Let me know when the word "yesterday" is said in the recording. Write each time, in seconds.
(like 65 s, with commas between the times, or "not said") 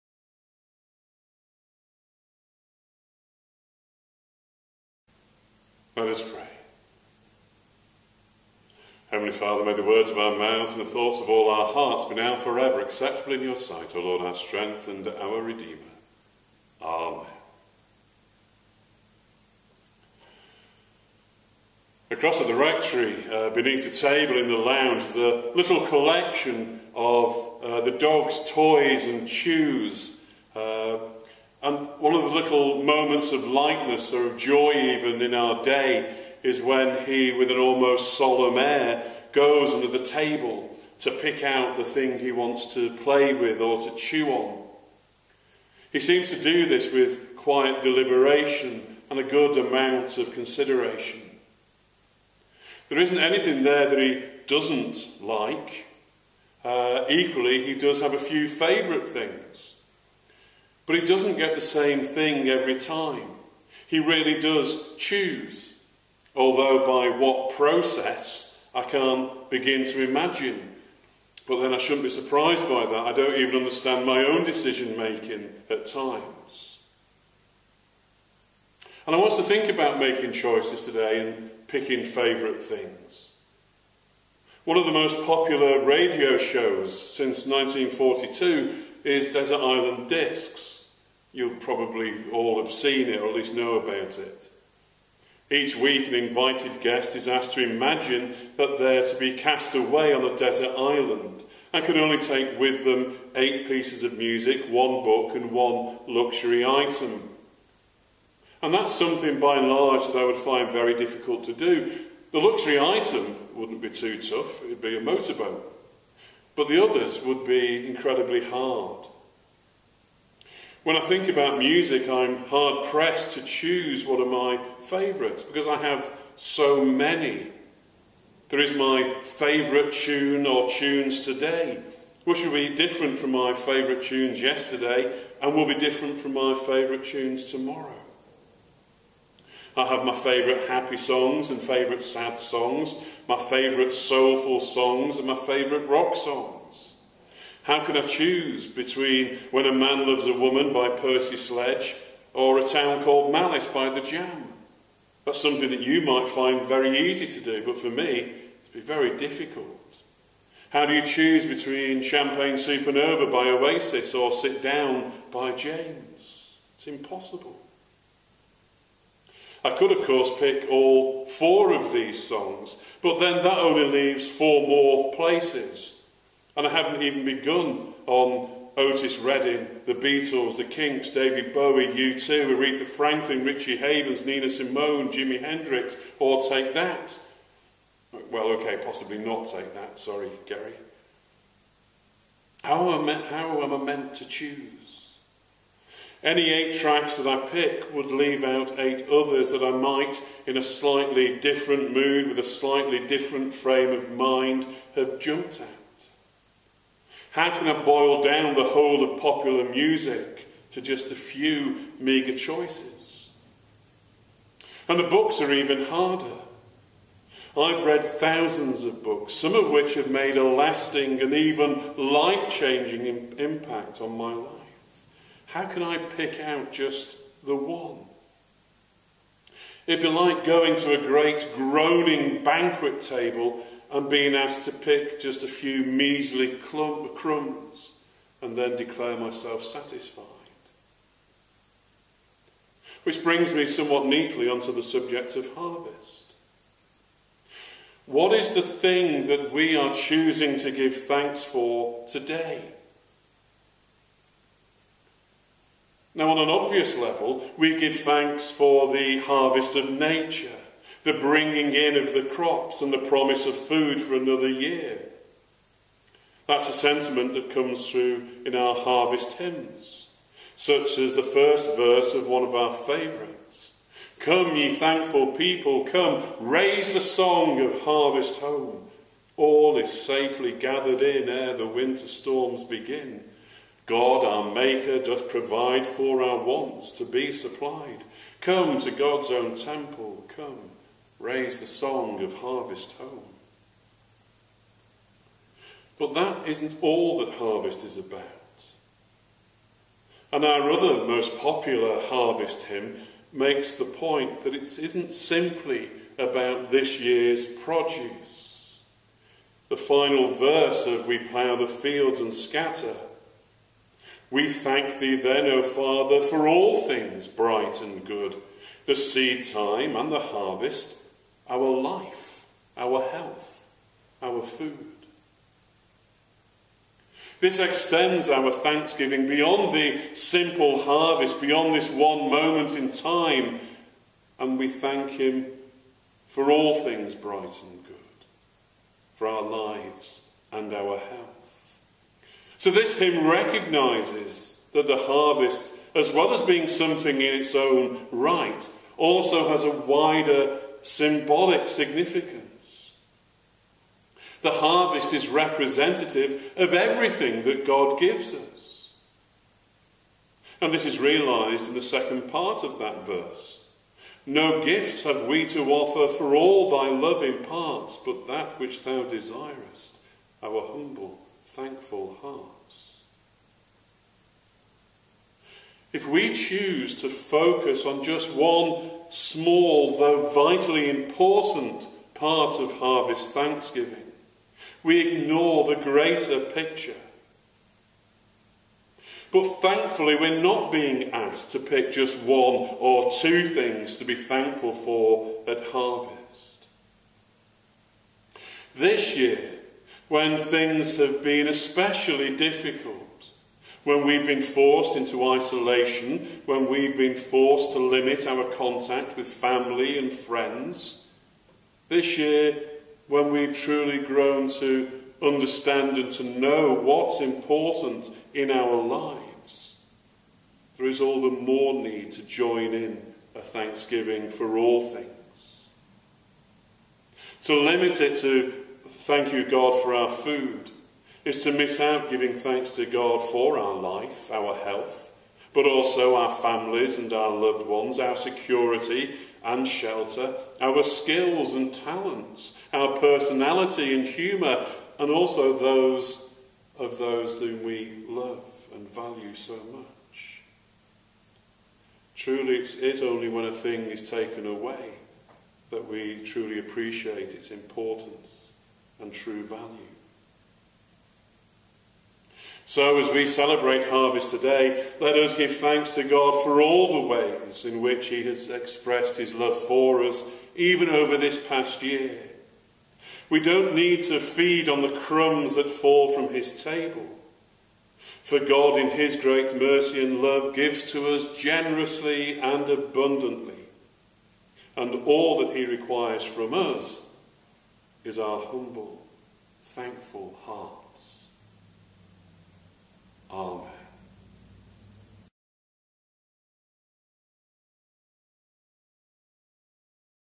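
134 s.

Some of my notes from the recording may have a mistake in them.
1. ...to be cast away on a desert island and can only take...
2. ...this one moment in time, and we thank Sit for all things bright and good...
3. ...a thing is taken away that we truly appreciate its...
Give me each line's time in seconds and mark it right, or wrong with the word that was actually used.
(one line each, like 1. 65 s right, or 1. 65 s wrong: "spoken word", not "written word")
1. 99 s right
2. 331 s wrong: "Him", not "Sit"
3. 453 s right.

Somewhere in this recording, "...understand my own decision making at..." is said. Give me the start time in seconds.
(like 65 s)
73 s.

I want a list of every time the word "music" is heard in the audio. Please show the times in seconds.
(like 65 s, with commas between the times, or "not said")
104 s, 121 s, 209 s.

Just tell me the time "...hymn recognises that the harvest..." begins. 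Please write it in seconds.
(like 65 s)
342 s.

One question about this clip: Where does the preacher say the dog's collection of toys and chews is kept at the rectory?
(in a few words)
Beneath the table in the lounge.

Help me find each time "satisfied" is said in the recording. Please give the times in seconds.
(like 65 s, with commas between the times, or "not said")
239 s.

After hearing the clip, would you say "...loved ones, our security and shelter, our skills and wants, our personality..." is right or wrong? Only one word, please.
wrong.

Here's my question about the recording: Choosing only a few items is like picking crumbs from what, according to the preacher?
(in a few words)
A great groaning banquet table.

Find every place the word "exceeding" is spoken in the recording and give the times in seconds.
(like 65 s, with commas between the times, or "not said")
not said.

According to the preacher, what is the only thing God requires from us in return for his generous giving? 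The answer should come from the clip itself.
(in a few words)
Our humble, thankful heart.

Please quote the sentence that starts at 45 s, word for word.
He seems to do this with quiet deliberation and a good amount of consideration.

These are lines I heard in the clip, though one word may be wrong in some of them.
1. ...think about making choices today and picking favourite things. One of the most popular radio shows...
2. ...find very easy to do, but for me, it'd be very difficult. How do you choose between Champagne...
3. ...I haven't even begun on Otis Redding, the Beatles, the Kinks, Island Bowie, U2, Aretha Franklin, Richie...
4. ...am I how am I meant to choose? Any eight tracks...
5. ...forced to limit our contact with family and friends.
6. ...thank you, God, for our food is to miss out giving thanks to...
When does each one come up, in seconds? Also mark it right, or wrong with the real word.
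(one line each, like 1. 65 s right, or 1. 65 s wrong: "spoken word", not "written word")
1. 79 s right
2. 156 s right
3. 176 s wrong: "David", not "Island"
4. 192 s right
5. 407 s right
6. 428 s right.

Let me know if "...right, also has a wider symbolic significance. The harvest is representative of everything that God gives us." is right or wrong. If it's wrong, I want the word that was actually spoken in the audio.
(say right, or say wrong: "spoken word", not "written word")
right.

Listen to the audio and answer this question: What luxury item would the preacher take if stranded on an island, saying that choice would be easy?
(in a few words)
A motorboat.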